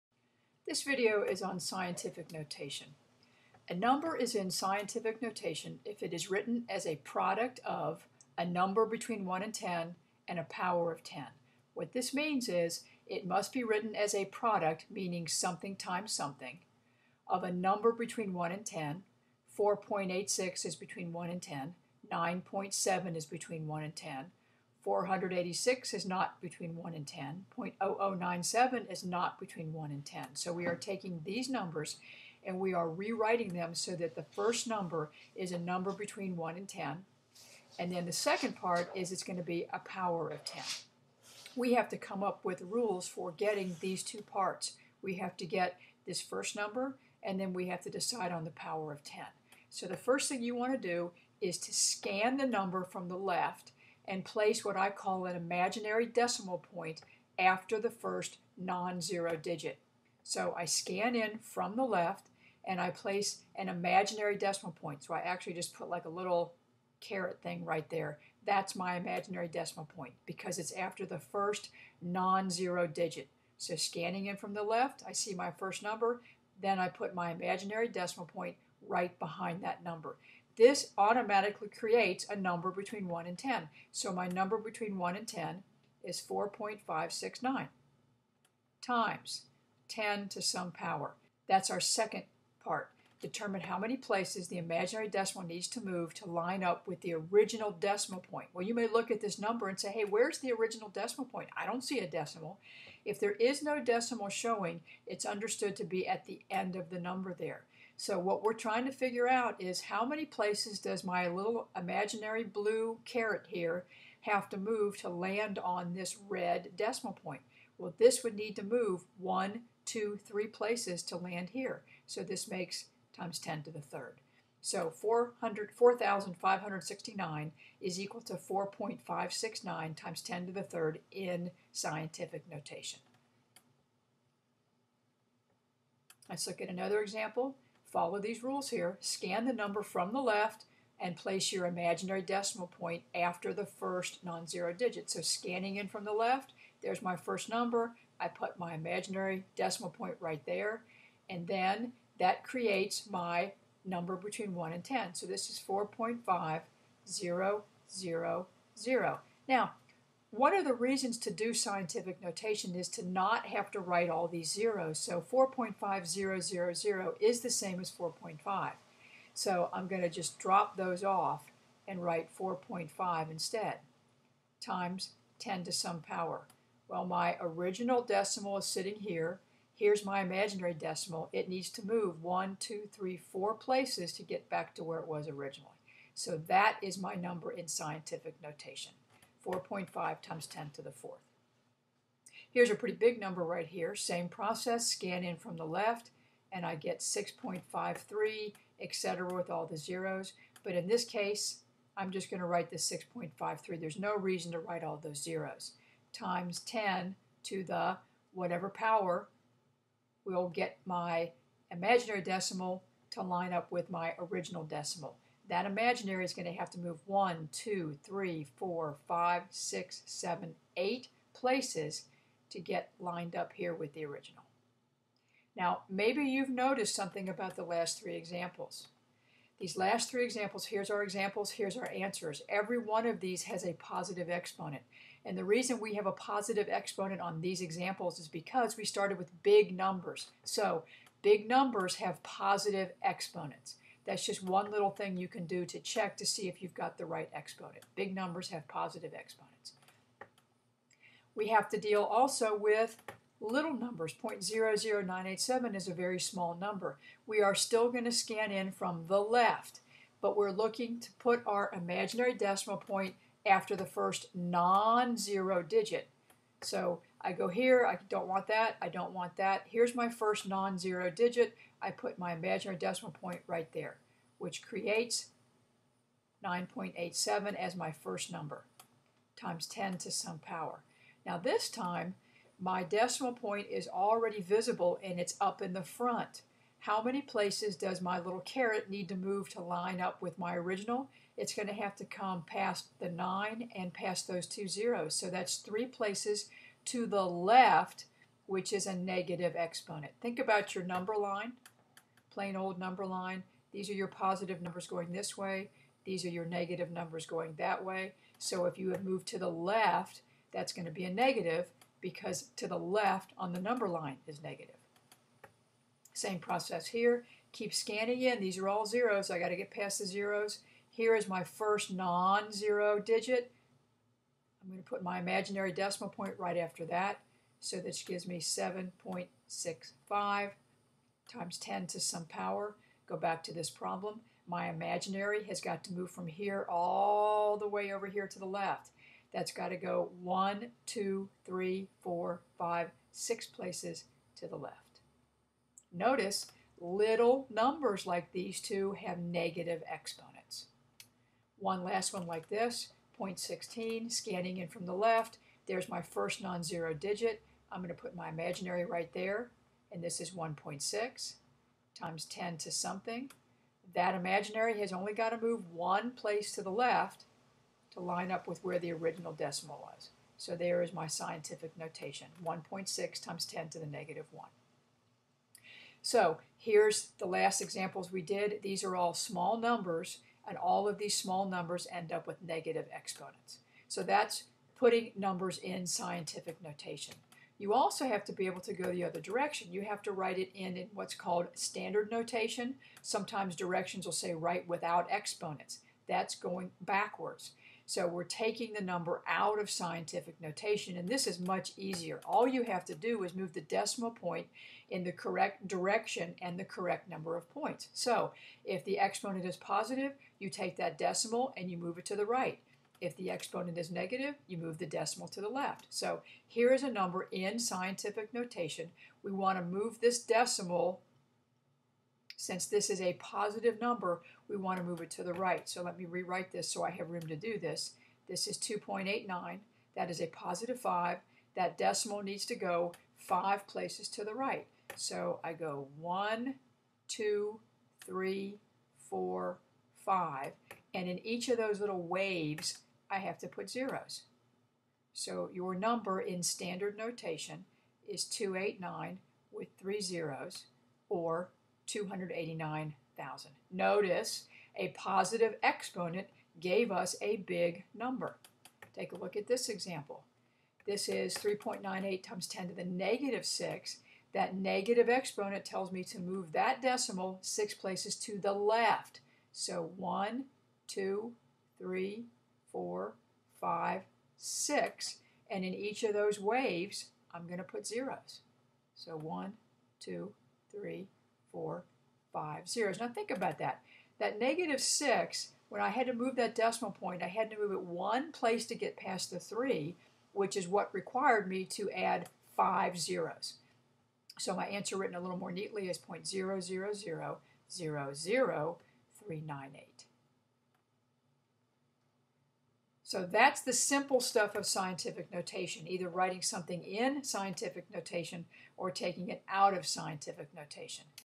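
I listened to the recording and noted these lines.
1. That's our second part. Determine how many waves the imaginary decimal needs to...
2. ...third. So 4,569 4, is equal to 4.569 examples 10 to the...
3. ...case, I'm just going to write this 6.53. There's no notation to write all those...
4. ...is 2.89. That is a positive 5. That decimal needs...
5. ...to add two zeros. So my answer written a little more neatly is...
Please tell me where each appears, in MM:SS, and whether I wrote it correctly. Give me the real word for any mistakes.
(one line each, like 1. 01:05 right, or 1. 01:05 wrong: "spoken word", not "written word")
1. 01:31 wrong: "places", not "waves"
2. 02:03 wrong: "times", not "examples"
3. 03:21 wrong: "reason", not "notation"
4. 07:08 right
5. 08:11 wrong: "five", not "two".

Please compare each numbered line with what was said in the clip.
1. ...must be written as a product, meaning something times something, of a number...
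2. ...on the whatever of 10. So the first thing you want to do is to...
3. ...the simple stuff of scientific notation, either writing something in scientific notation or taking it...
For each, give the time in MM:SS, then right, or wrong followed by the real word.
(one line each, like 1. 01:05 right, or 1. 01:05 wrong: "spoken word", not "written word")
1. 00:13 right
2. 00:48 wrong: "power", not "whatever"
3. 08:23 right.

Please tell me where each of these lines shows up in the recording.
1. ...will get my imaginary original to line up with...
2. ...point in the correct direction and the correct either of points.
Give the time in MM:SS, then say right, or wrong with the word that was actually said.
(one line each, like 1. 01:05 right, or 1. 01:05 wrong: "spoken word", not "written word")
1. 03:30 wrong: "decimal", not "original"
2. 06:44 wrong: "number", not "either".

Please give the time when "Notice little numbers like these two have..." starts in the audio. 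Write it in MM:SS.
05:45.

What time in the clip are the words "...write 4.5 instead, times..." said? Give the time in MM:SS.
02:52.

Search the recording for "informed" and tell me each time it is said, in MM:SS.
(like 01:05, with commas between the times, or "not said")
not said.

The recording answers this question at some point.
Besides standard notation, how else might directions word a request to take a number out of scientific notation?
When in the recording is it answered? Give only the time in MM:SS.
06:34.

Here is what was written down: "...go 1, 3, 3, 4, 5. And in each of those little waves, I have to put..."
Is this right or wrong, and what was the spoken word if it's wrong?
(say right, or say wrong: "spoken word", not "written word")
wrong: "2", not "3".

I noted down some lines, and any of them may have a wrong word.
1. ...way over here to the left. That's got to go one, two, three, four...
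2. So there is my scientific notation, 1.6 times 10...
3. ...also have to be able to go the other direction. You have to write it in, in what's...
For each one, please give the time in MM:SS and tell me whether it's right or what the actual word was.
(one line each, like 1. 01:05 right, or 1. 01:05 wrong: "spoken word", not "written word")
1. 05:37 right
2. 06:10 right
3. 06:27 right.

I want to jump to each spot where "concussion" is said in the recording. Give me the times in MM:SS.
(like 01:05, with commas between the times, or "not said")
not said.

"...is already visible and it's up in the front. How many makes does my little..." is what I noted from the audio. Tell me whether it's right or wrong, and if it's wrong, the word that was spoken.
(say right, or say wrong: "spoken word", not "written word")
wrong: "places", not "makes".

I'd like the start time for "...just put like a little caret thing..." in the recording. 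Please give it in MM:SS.
01:05.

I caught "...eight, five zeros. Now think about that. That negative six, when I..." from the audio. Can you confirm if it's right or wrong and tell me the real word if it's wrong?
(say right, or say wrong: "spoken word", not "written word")
wrong: "four", not "eight".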